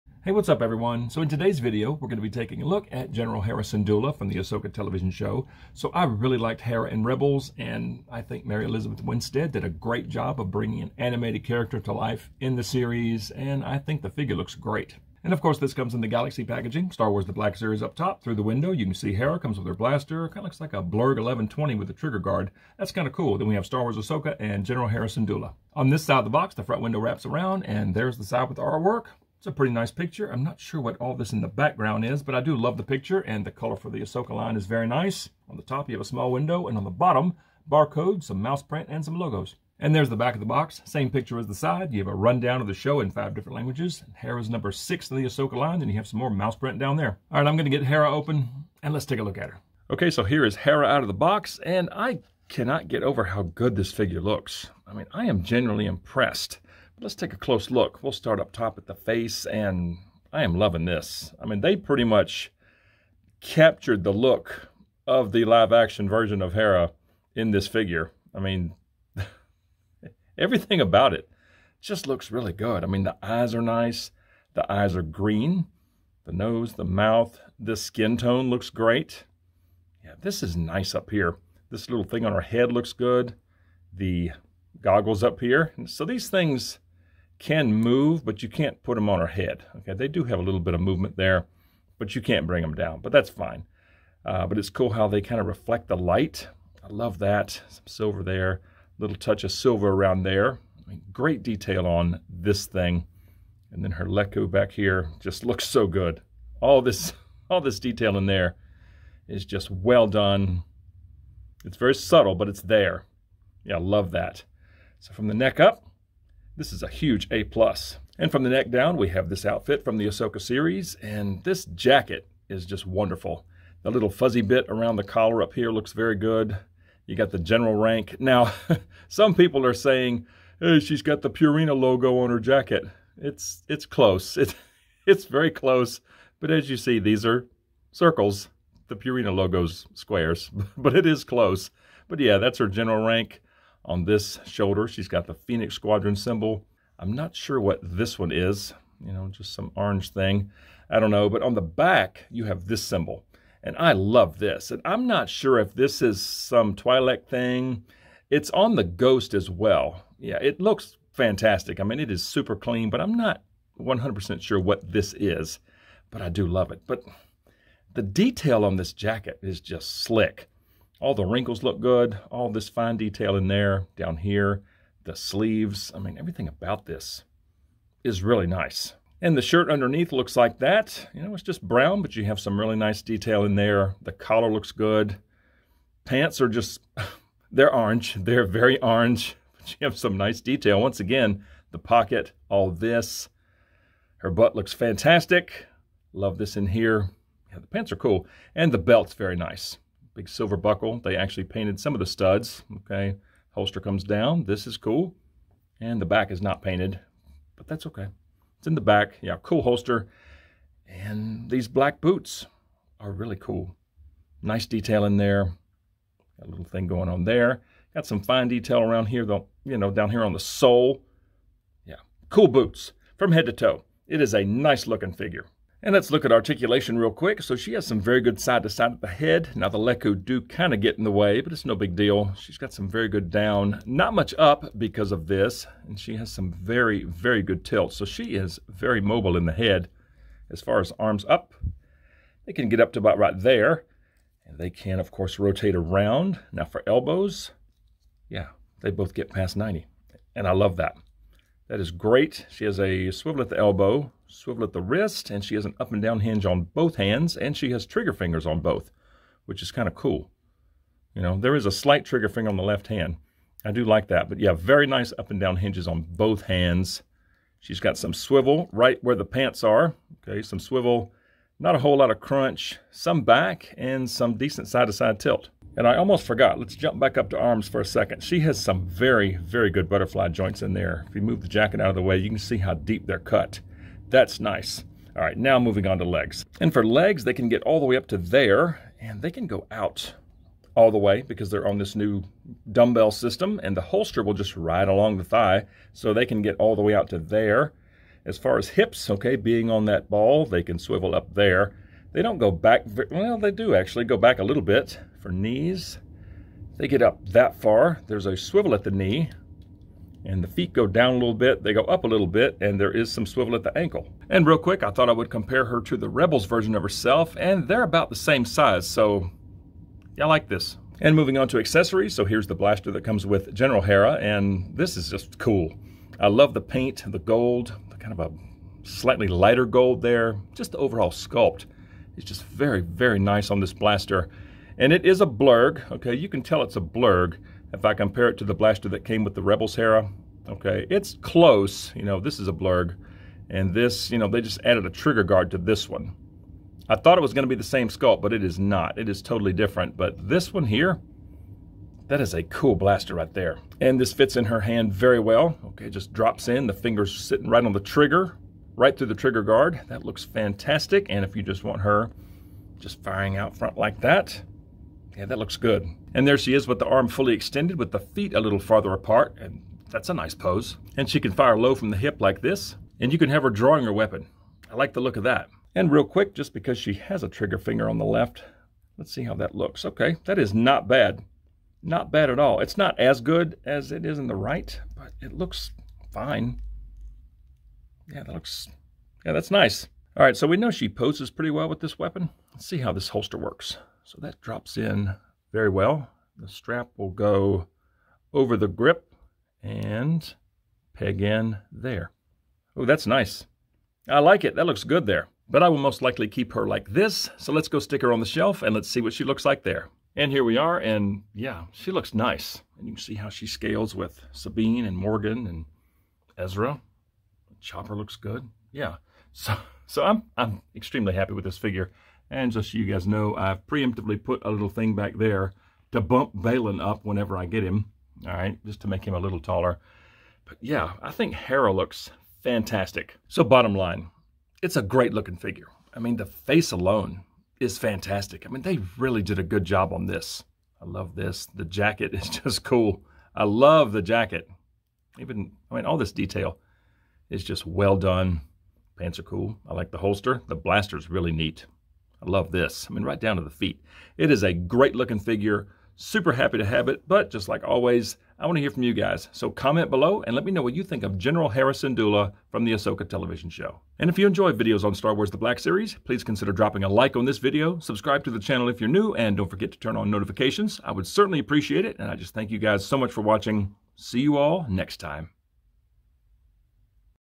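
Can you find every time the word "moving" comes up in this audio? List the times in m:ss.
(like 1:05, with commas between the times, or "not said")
4:45, 5:21.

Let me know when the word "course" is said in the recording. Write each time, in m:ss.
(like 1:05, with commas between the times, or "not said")
0:15, 4:05.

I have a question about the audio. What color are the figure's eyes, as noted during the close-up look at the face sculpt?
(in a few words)
Green.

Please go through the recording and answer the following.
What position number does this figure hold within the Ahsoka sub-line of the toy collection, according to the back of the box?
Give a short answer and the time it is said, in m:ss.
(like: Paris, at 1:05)
6, at 0:44.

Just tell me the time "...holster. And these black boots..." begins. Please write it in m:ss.
3:29.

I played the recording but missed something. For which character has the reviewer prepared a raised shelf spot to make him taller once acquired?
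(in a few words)
Baylan.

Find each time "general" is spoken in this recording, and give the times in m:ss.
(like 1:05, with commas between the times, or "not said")
0:03, 0:24, 2:07, 2:22, 5:23, 7:41.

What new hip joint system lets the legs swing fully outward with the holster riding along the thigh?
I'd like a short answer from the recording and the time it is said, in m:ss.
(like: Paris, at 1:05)
Dumbbell system, at 4:52.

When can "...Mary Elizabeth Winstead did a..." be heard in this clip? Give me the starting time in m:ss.
0:08.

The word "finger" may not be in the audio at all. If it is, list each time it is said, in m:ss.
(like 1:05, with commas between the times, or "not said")
4:18, 4:22, 5:56, 6:17.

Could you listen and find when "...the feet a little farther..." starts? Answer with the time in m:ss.
6:07.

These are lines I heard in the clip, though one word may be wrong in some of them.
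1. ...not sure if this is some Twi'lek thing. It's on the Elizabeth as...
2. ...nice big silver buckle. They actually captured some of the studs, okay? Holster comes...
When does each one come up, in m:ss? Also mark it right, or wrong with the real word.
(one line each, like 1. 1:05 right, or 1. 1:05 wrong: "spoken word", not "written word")
1. 2:35 wrong: "Ghost", not "Elizabeth"
2. 3:19 wrong: "painted", not "captured".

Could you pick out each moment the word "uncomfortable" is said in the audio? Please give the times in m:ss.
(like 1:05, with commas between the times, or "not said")
not said.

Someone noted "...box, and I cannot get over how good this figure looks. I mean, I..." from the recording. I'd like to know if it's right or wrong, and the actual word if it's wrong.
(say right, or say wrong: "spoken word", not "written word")
right.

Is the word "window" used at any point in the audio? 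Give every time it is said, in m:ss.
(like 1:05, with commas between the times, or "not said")
0:18, 0:26, 0:36.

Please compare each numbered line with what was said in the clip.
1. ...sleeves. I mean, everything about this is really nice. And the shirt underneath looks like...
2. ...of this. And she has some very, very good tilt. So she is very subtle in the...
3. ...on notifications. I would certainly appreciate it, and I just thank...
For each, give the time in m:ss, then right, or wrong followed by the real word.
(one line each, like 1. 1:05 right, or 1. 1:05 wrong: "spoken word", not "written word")
1. 2:55 right
2. 3:55 wrong: "mobile", not "subtle"
3. 7:49 right.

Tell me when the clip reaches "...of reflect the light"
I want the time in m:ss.
1:35.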